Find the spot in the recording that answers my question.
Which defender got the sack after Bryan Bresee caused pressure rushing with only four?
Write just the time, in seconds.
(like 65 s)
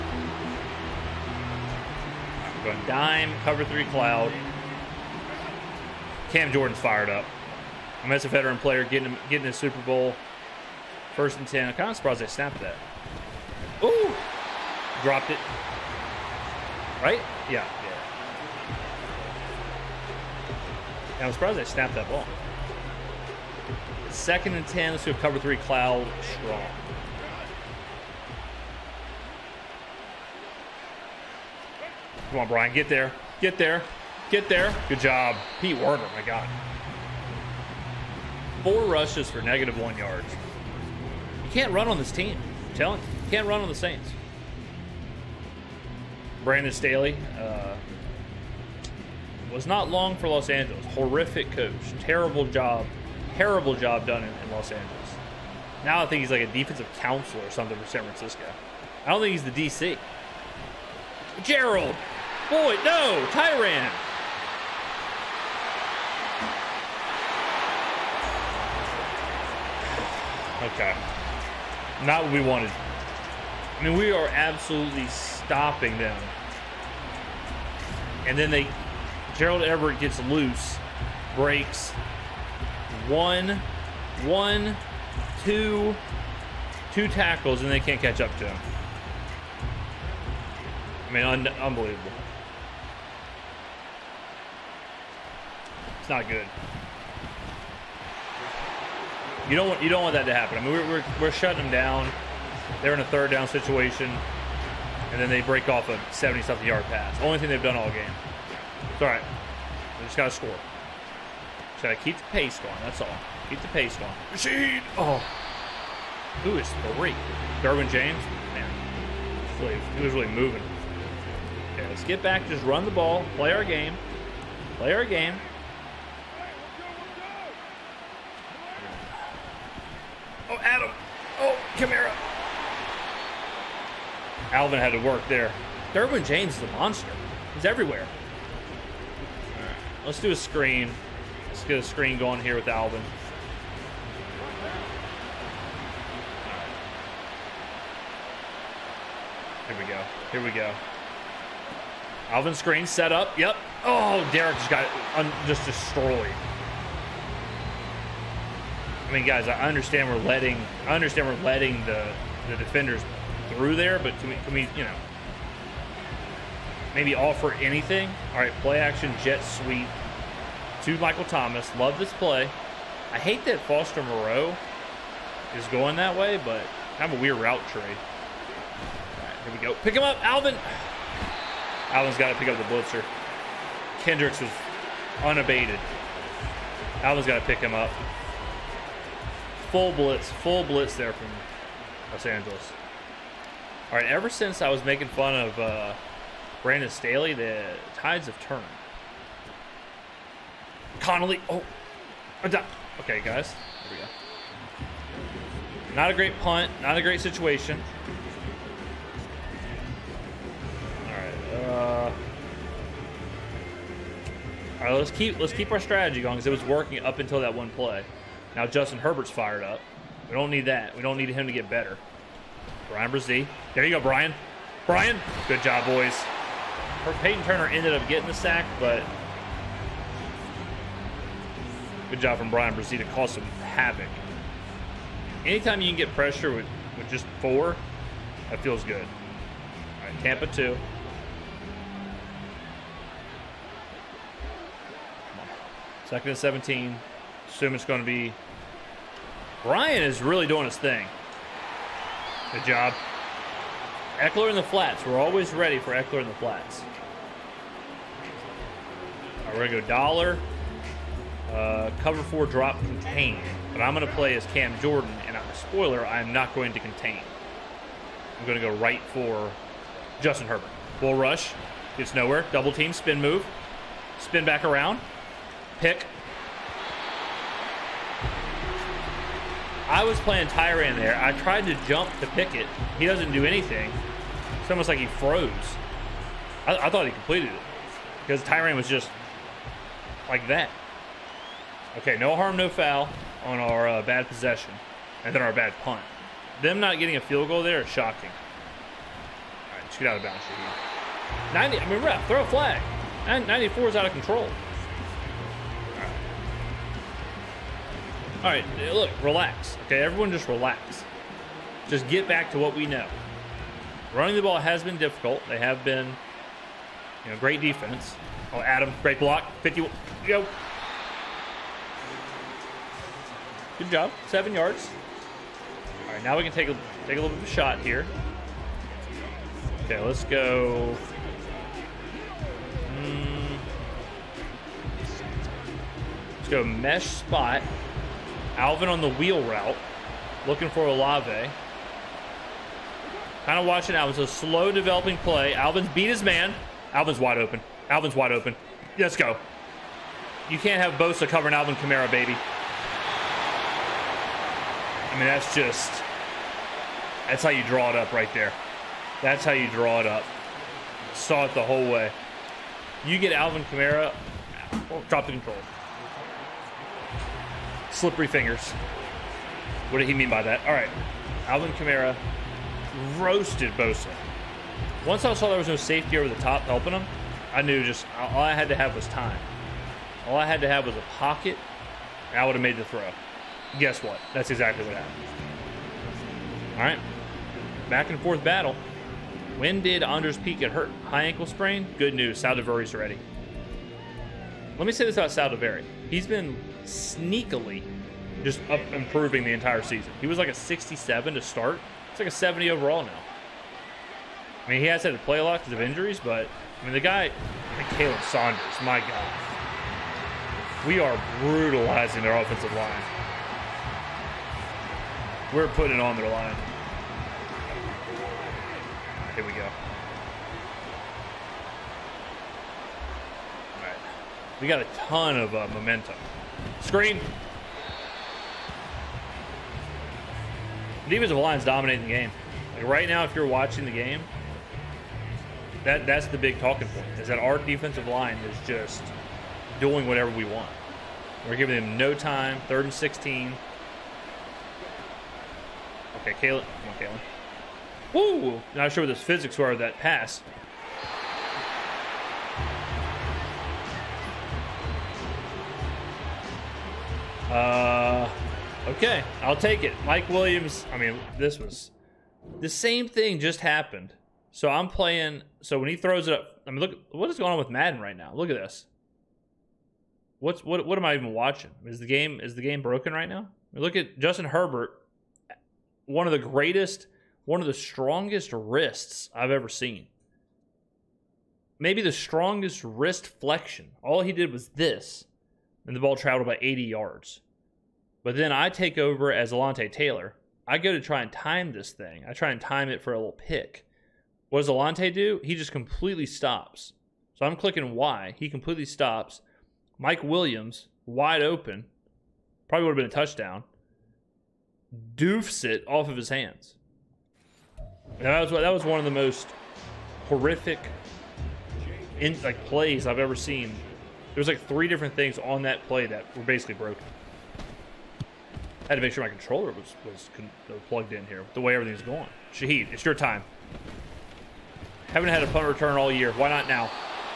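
227 s.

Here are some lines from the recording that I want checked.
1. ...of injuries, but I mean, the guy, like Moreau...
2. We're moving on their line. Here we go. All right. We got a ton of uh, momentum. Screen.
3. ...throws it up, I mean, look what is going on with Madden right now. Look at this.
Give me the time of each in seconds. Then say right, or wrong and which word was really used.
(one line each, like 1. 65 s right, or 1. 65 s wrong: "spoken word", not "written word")
1. 405 s wrong: "Khalen", not "Moreau"
2. 415 s wrong: "putting", not "moving"
3. 465 s right.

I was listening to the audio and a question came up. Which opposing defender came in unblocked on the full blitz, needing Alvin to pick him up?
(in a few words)
Kendricks.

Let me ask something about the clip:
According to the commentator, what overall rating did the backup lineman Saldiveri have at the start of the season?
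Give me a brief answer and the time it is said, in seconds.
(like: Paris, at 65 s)
67, at 400 s.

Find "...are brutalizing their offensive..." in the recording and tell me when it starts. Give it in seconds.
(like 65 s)
410 s.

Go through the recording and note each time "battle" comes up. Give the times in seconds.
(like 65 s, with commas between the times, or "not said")
388 s.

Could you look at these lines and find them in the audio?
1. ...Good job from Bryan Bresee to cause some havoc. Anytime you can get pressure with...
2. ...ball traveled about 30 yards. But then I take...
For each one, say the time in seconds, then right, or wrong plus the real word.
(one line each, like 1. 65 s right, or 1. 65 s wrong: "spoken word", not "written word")
1. 232 s right
2. 485 s wrong: "80", not "30".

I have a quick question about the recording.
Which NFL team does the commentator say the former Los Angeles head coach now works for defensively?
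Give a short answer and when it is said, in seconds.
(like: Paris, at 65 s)
San Francisco, at 57 s.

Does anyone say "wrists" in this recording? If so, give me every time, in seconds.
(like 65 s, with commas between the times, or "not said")
478 s, 482 s.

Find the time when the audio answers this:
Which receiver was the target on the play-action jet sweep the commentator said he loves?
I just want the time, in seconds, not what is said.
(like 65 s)
170 s.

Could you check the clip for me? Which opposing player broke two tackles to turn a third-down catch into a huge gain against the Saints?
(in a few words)
Gerald Everett.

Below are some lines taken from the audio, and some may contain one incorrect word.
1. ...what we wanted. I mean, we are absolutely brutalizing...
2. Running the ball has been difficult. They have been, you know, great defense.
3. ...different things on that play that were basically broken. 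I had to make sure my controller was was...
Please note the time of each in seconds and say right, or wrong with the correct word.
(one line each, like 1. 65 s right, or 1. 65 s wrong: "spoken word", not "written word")
1. 72 s wrong: "stopping", not "brutalizing"
2. 314 s right
3. 514 s right.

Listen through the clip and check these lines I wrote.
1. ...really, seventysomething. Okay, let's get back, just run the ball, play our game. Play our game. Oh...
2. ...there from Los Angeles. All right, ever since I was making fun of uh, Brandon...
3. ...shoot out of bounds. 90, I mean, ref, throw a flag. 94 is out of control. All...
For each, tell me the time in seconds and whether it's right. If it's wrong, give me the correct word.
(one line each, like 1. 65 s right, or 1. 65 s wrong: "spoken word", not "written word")
1. 120 s wrong: "moving", not "seventysomething"
2. 190 s right
3. 299 s right.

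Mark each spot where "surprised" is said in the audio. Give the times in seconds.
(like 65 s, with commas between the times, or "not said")
11 s, 21 s.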